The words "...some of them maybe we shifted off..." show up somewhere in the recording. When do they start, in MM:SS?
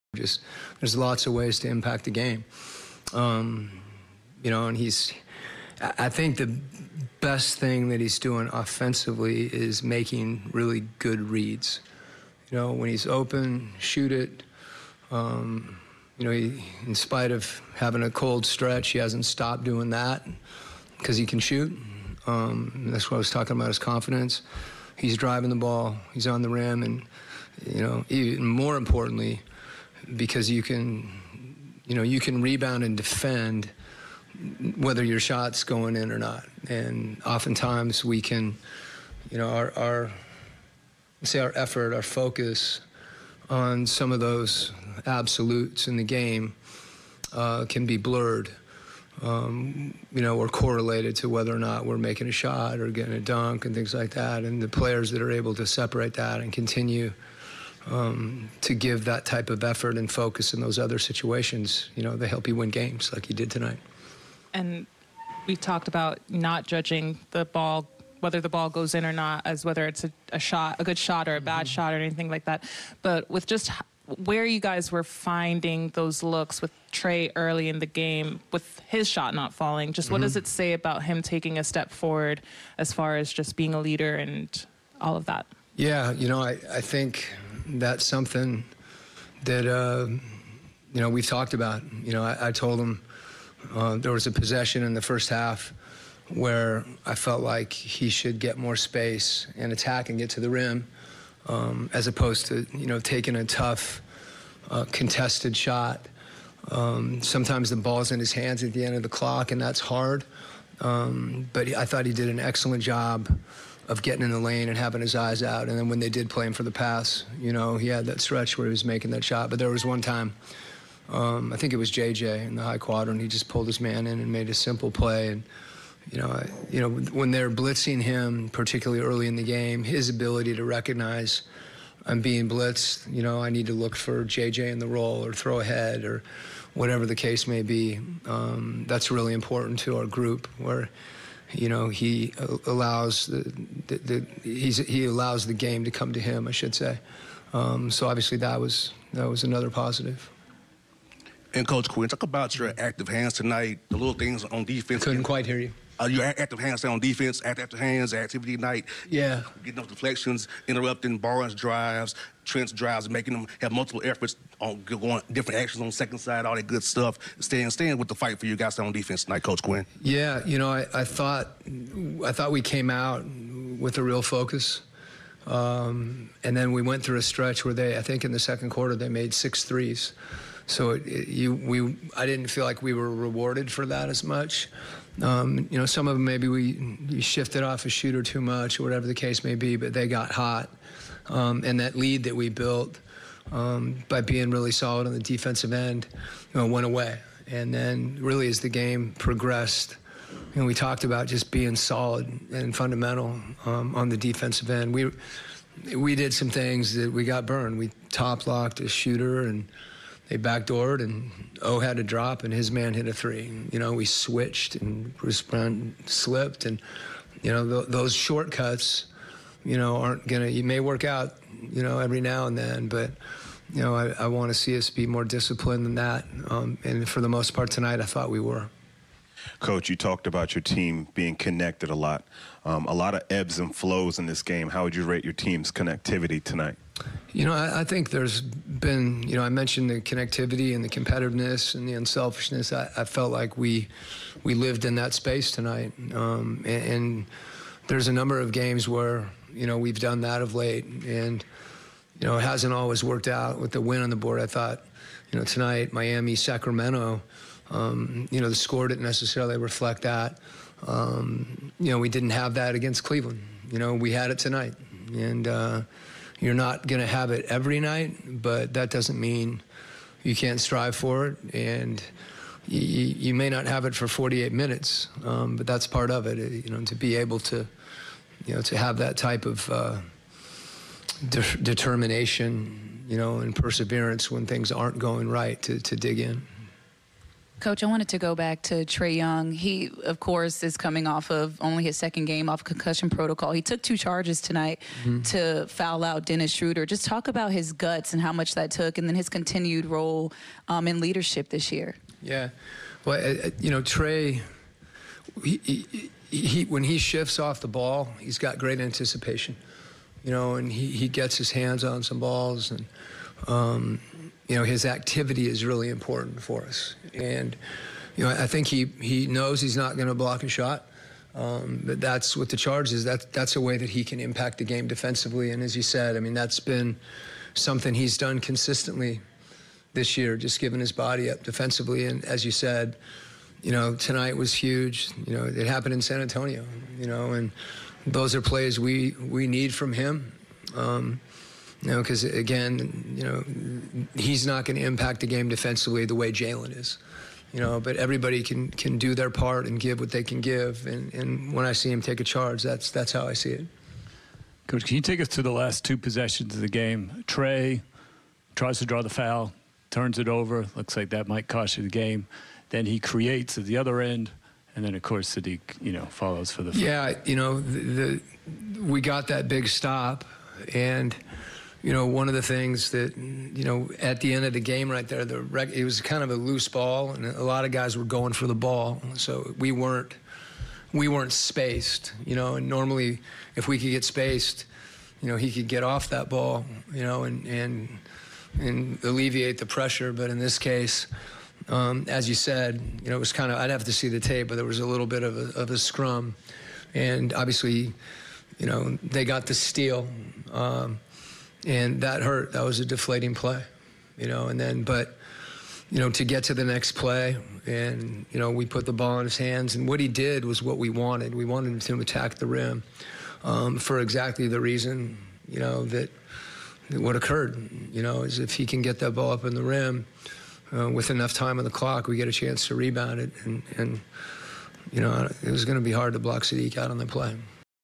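03:05.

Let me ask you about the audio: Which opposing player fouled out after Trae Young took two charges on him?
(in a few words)
Dennis Schroeder.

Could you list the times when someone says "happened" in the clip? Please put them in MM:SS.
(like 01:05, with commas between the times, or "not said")
05:35.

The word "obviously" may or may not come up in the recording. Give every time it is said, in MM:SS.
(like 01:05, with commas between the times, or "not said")
02:28, 06:37.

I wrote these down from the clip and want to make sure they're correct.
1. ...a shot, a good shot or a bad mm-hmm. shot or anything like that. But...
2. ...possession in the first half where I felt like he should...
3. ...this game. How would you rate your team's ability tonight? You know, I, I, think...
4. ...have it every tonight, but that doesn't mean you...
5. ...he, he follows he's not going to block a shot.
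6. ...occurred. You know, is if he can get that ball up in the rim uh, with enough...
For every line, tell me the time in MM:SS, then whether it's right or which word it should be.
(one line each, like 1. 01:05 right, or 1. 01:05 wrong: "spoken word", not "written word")
1. 01:10 right
2. 01:34 right
3. 03:54 wrong: "connectivity", not "ability"
4. 04:27 wrong: "night", not "tonight"
5. 05:18 wrong: "knows", not "follows"
6. 06:57 right.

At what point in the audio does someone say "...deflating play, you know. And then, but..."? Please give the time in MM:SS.
06:42.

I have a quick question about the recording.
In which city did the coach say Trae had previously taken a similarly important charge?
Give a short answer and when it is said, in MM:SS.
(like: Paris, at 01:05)
San Antonio, at 05:36.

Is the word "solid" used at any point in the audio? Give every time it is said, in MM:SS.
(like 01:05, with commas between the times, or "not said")
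03:14, 03:21.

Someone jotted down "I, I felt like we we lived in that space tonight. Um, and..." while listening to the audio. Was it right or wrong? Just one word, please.
right.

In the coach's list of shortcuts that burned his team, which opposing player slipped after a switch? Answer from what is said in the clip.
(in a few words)
Bruce Brown.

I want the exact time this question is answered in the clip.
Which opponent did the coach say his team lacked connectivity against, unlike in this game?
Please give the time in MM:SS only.
04:23.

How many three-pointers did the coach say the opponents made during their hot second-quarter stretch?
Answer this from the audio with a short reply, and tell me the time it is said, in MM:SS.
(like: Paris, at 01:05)
6, at 02:59.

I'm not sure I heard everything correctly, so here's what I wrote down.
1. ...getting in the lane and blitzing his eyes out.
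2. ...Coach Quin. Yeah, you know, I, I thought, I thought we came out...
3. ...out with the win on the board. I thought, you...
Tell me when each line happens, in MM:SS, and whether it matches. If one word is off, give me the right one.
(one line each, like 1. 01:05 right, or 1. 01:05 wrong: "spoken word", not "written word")
1. 01:54 wrong: "having", not "blitzing"
2. 02:49 right
3. 04:13 right.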